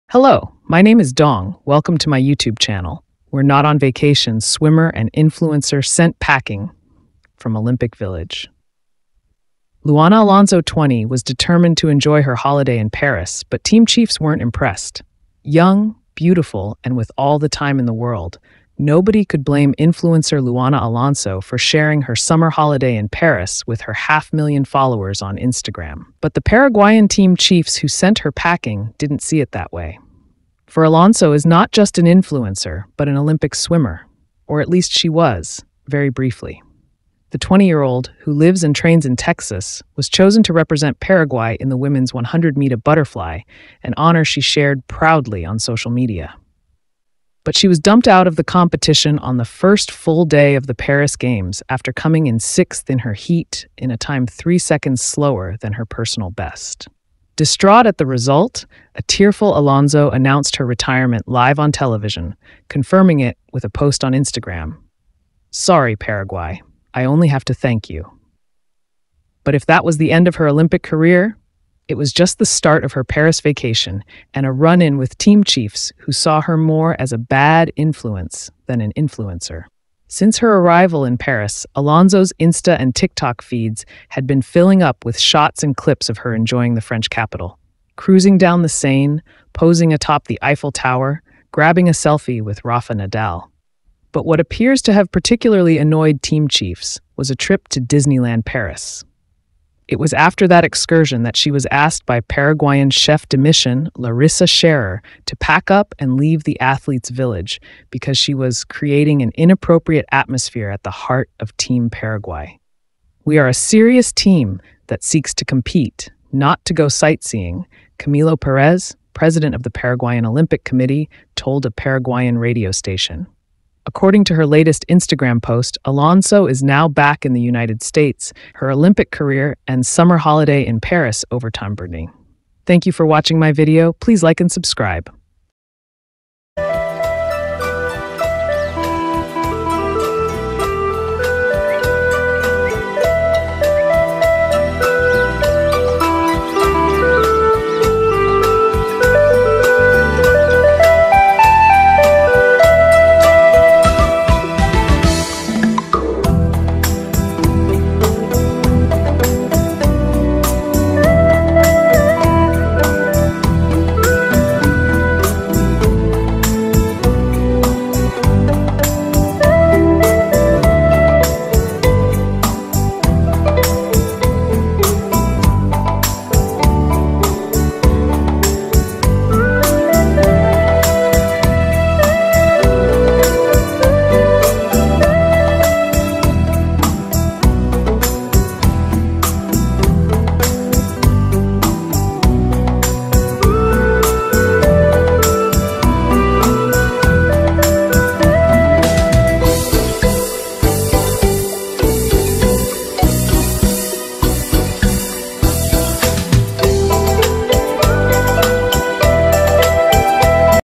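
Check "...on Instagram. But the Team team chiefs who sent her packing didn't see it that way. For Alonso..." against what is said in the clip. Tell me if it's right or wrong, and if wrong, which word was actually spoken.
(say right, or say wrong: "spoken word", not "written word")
wrong: "Paraguayan", not "Team".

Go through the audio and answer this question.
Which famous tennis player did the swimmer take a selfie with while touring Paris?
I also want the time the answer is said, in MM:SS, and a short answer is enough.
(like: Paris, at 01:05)
Rafa Nadal, at 01:32.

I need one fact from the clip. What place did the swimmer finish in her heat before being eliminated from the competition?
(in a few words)
sixth.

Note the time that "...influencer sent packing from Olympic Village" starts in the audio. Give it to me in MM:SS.
00:05.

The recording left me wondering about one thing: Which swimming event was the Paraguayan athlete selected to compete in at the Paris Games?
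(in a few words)
100 meter butterfly.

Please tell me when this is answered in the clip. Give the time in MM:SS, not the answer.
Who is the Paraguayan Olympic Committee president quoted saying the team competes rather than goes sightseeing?
01:57.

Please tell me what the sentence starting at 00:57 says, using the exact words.
Distraught at the result, a tearful Alonso announced her retirement live on television, confirming it with a post on Instagram.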